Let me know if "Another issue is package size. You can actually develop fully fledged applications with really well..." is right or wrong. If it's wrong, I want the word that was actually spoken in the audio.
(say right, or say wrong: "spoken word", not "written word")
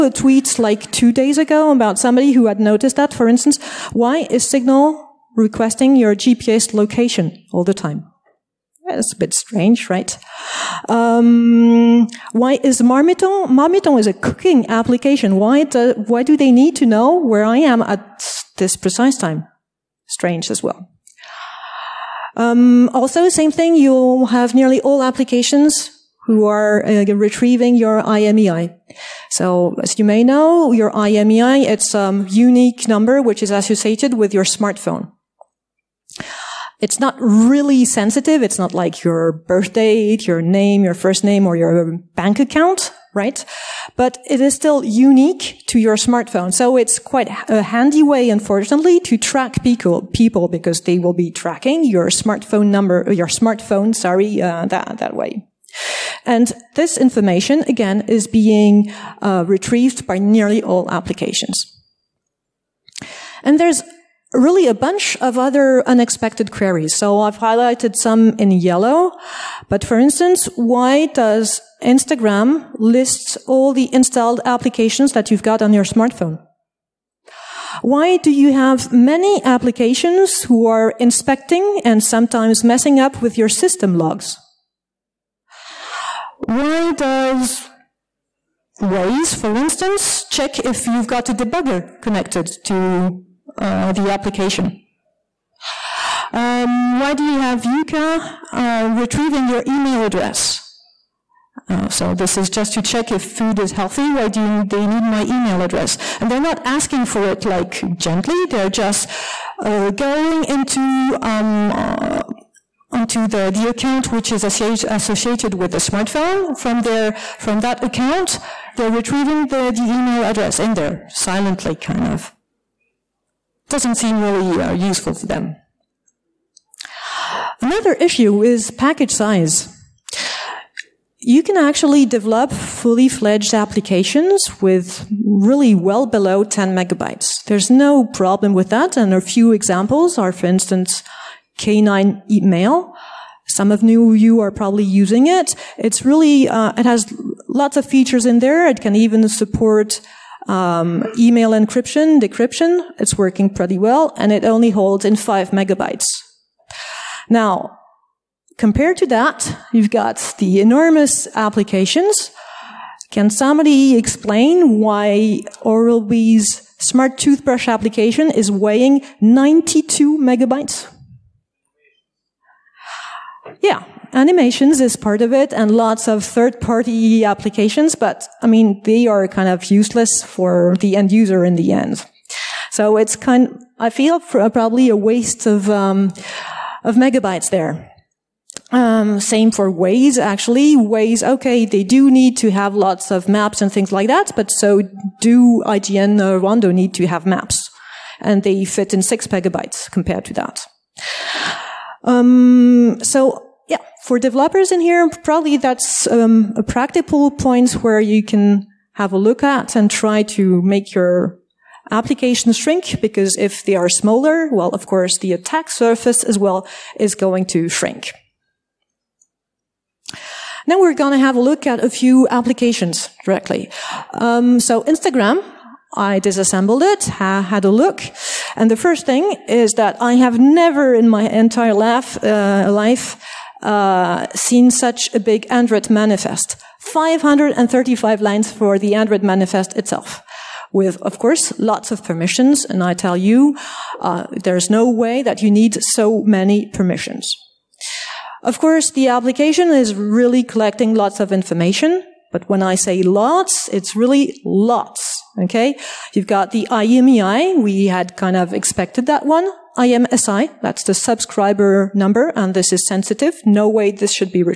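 right.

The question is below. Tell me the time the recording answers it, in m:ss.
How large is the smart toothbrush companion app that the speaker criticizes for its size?
2:49.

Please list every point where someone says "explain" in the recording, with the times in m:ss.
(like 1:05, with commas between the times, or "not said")
2:43.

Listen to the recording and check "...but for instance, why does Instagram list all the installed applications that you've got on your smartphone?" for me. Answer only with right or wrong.
right.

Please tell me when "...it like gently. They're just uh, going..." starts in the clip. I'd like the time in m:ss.
1:47.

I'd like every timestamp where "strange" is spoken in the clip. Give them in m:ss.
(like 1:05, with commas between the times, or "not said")
0:09, 0:20.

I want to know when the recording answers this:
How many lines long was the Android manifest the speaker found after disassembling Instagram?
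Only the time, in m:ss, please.
3:56.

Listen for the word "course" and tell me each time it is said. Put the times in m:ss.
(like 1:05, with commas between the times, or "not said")
3:34, 4:01, 4:08.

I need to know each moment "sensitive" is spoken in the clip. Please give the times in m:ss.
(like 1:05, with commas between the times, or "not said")
0:37, 4:22.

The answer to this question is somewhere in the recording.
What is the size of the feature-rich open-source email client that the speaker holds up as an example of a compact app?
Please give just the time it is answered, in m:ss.
2:35.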